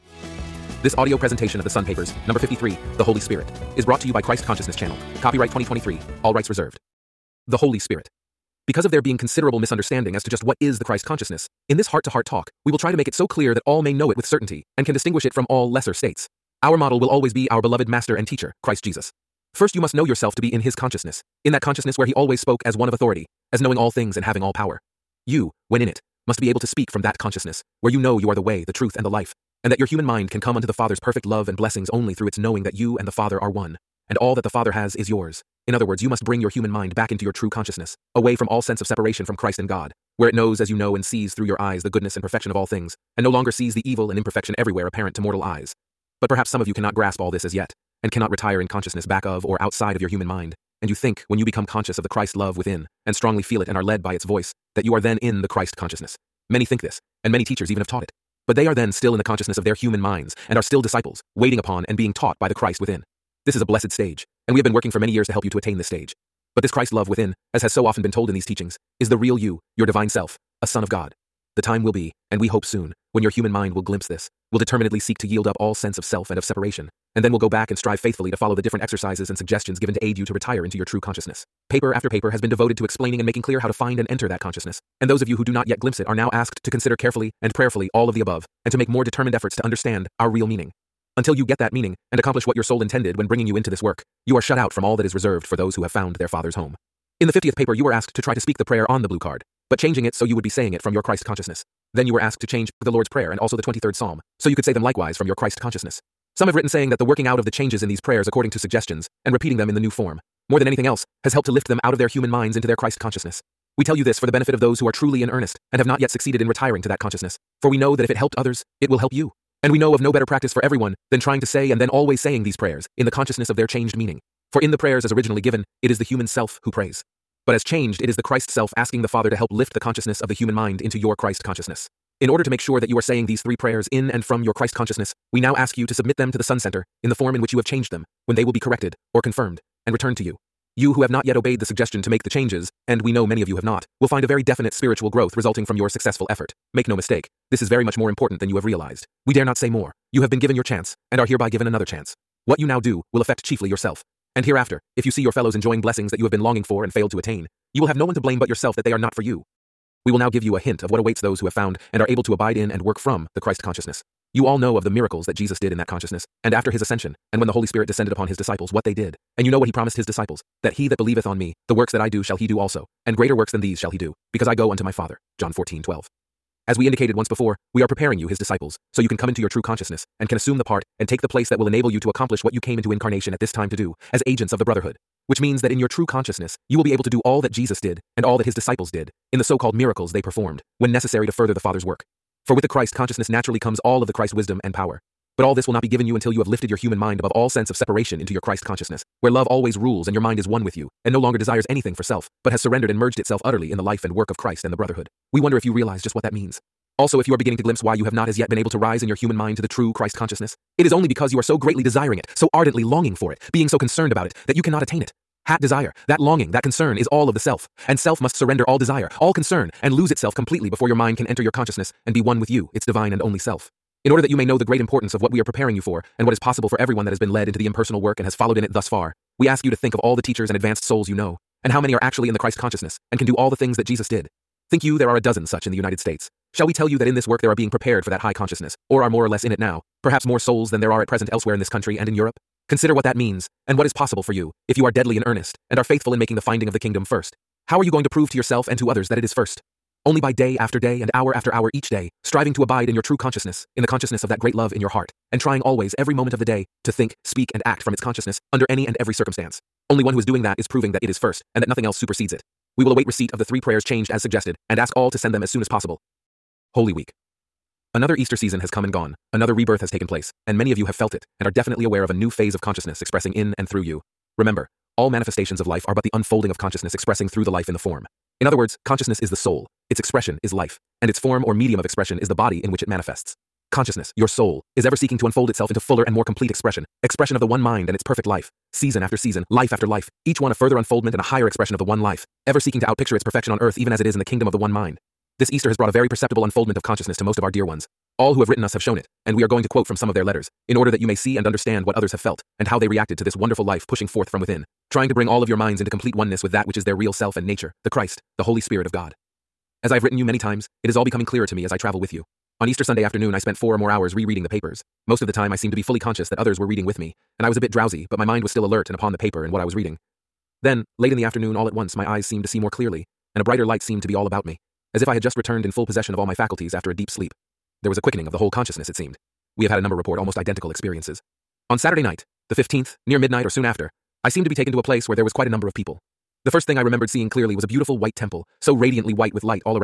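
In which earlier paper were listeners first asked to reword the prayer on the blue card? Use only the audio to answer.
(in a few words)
50th.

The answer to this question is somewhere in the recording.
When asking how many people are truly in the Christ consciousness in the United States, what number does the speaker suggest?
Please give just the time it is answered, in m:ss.
3:55.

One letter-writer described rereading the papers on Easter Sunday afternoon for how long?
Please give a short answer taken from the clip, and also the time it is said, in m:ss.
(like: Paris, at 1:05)
four or more hours, at 5:13.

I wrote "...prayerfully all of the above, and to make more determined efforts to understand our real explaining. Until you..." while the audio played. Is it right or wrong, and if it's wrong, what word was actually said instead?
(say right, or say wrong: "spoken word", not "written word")
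wrong: "meaning", not "explaining".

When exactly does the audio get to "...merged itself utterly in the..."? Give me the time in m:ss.
3:22.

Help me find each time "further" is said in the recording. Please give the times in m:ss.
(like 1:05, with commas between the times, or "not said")
3:11, 4:50.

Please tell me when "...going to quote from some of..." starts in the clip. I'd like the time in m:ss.
4:59.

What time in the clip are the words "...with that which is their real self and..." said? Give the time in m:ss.
5:06.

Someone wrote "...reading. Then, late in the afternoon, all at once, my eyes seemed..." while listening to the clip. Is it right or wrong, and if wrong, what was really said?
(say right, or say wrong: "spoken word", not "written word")
right.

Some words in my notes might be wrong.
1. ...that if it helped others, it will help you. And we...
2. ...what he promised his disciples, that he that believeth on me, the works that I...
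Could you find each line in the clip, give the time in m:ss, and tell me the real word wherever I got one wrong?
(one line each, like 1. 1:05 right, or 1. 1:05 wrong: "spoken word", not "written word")
1. 1:57 right
2. 2:49 right.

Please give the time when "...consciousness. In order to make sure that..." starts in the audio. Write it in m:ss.
2:11.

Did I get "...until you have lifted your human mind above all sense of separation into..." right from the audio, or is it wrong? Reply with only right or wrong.
right.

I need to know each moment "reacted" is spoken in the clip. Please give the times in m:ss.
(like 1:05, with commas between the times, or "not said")
5:02.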